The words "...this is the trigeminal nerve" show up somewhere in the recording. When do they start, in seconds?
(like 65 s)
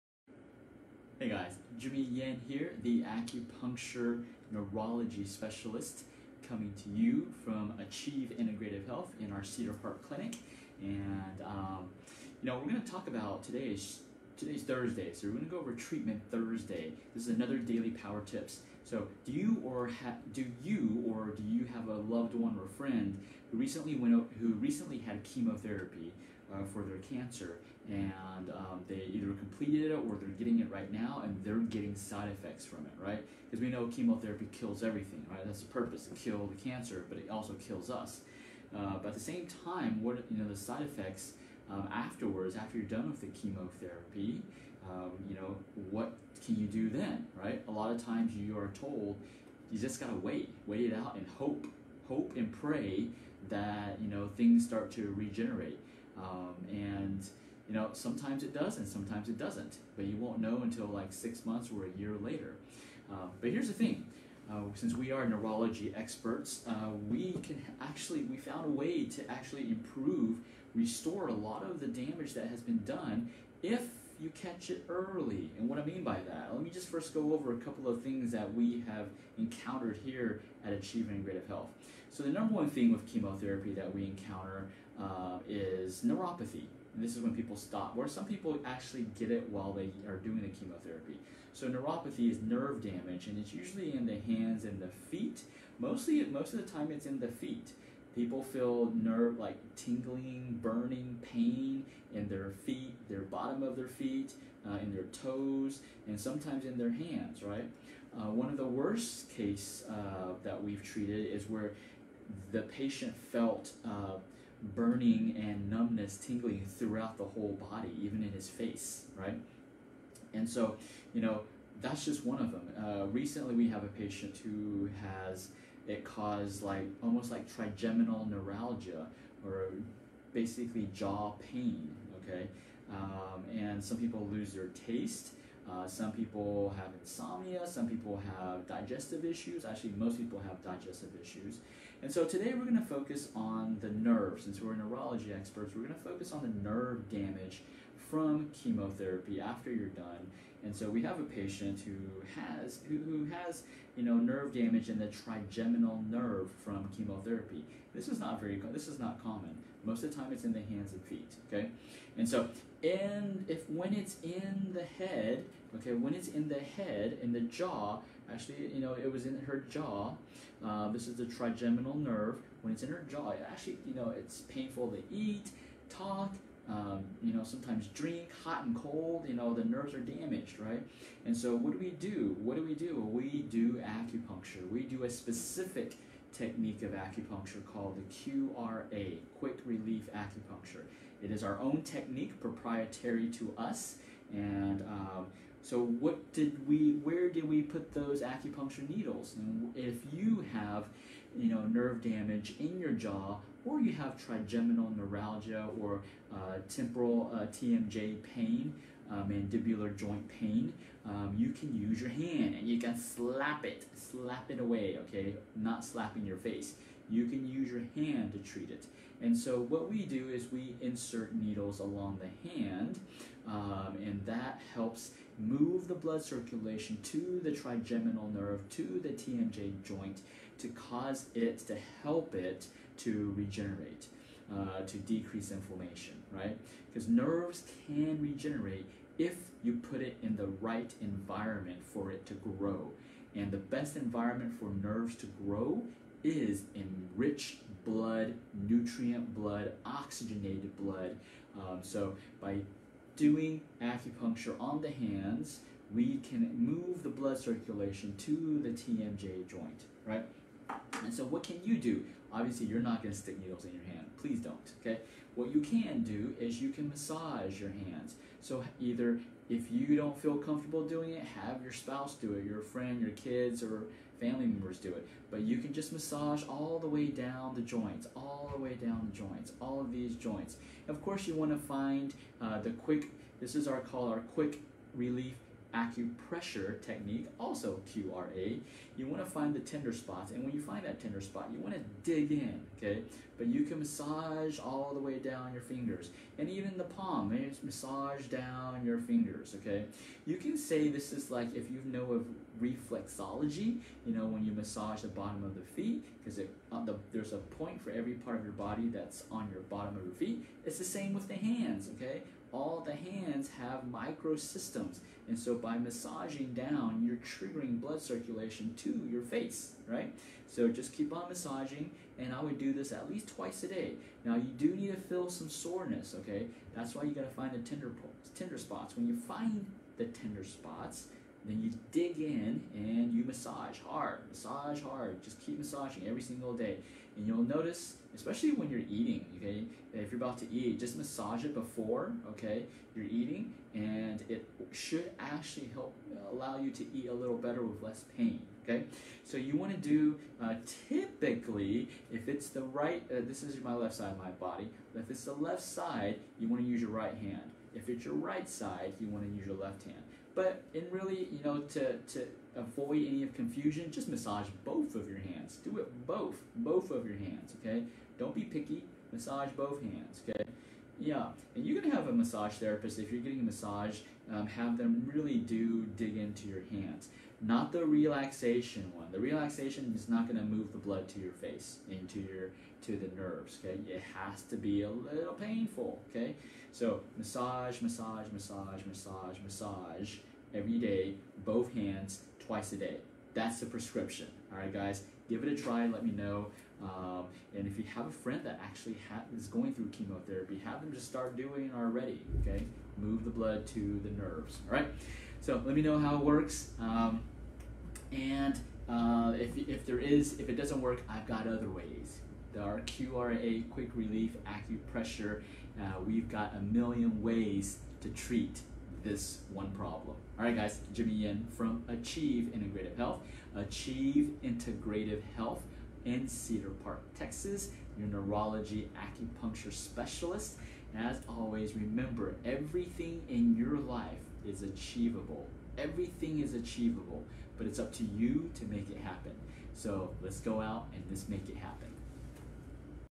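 170 s.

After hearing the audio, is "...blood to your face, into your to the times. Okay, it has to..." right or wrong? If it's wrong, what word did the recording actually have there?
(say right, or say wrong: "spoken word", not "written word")
wrong: "nerves", not "times".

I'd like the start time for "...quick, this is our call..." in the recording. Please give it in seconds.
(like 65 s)
282 s.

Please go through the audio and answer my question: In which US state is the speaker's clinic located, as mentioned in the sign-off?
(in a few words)
Texas.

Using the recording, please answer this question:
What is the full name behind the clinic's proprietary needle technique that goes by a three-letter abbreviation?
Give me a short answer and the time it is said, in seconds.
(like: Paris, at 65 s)
Quick Relief Acupuncture, at 189 s.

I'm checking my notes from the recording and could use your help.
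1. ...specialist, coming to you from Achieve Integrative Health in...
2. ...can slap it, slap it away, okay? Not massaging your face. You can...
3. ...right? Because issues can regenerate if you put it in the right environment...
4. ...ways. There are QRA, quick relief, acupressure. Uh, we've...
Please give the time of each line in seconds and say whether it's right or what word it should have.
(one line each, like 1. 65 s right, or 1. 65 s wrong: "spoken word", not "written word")
1. 5 s right
2. 212 s wrong: "slapping", not "massaging"
3. 236 s wrong: "nerves", not "issues"
4. 411 s right.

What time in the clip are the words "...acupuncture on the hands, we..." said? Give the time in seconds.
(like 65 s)
253 s.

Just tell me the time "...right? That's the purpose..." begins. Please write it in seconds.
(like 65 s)
35 s.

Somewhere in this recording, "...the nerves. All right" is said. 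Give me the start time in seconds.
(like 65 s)
404 s.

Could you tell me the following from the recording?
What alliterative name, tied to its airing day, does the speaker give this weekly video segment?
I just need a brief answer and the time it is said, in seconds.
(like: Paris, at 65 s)
Treatment Thursday, at 15 s.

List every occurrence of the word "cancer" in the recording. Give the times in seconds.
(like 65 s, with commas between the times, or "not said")
26 s, 36 s.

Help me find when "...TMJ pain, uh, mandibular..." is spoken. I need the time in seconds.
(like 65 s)
207 s.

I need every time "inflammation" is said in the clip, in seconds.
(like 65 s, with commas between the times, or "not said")
235 s.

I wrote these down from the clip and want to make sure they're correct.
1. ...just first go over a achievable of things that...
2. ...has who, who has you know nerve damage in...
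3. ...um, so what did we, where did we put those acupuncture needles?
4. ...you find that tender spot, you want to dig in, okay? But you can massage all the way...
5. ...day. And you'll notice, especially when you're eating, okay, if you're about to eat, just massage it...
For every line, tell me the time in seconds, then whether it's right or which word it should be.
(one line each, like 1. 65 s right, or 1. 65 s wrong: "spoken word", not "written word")
1. 76 s wrong: "couple", not "achievable"
2. 152 s right
3. 194 s right
4. 290 s right
5. 336 s right.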